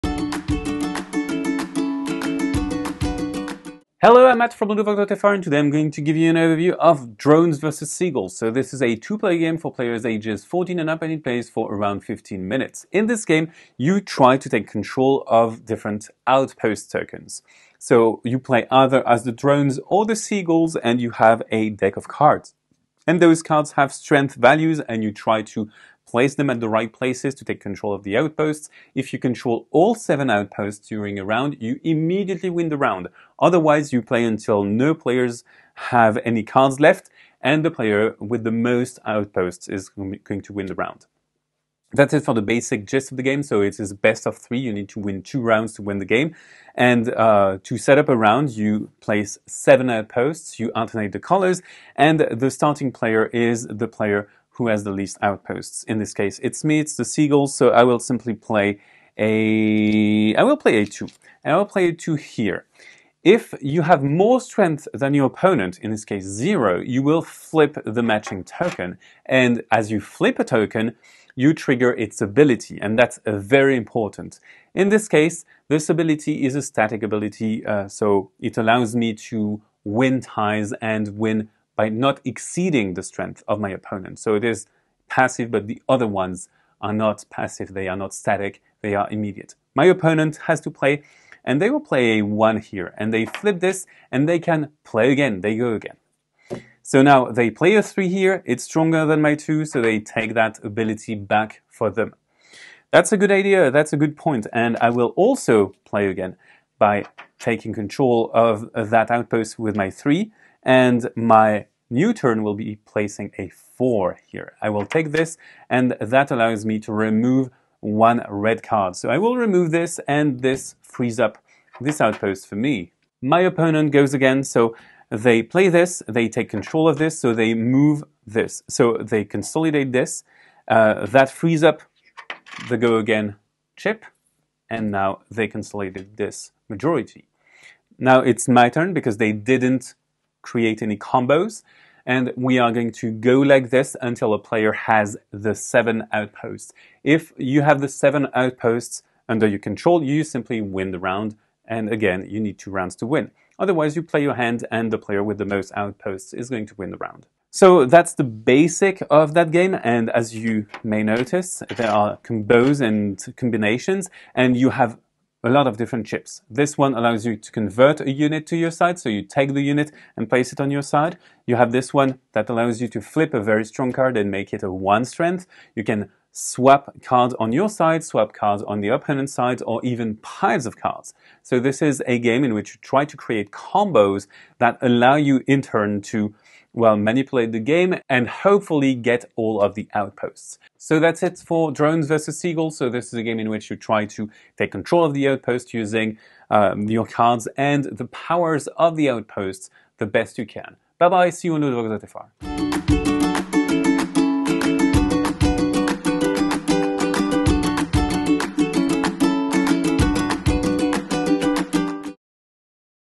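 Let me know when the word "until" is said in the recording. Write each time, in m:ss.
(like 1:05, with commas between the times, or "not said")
0:34, 2:24.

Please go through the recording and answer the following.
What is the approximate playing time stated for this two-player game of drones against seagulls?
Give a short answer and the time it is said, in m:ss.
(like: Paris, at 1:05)
15 minutes, at 0:12.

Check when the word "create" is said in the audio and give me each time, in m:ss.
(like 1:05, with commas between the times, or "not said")
2:20, 3:03.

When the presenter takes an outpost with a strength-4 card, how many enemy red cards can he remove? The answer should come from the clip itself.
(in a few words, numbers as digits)
1.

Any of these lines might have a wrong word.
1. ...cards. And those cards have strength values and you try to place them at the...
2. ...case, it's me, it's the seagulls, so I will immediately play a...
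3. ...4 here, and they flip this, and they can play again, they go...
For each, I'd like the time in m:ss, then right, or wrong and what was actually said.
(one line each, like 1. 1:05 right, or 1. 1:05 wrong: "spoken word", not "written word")
1. 0:22 right
2. 0:56 wrong: "simply", not "immediately"
3. 1:32 wrong: "1", not "4".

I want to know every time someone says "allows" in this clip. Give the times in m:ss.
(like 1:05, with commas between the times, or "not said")
1:18, 1:56, 2:46, 2:52, 3:04.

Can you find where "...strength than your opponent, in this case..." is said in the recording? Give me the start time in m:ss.
1:04.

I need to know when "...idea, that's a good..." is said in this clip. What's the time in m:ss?
1:43.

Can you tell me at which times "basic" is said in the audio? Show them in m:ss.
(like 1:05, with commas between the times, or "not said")
0:42, 2:38.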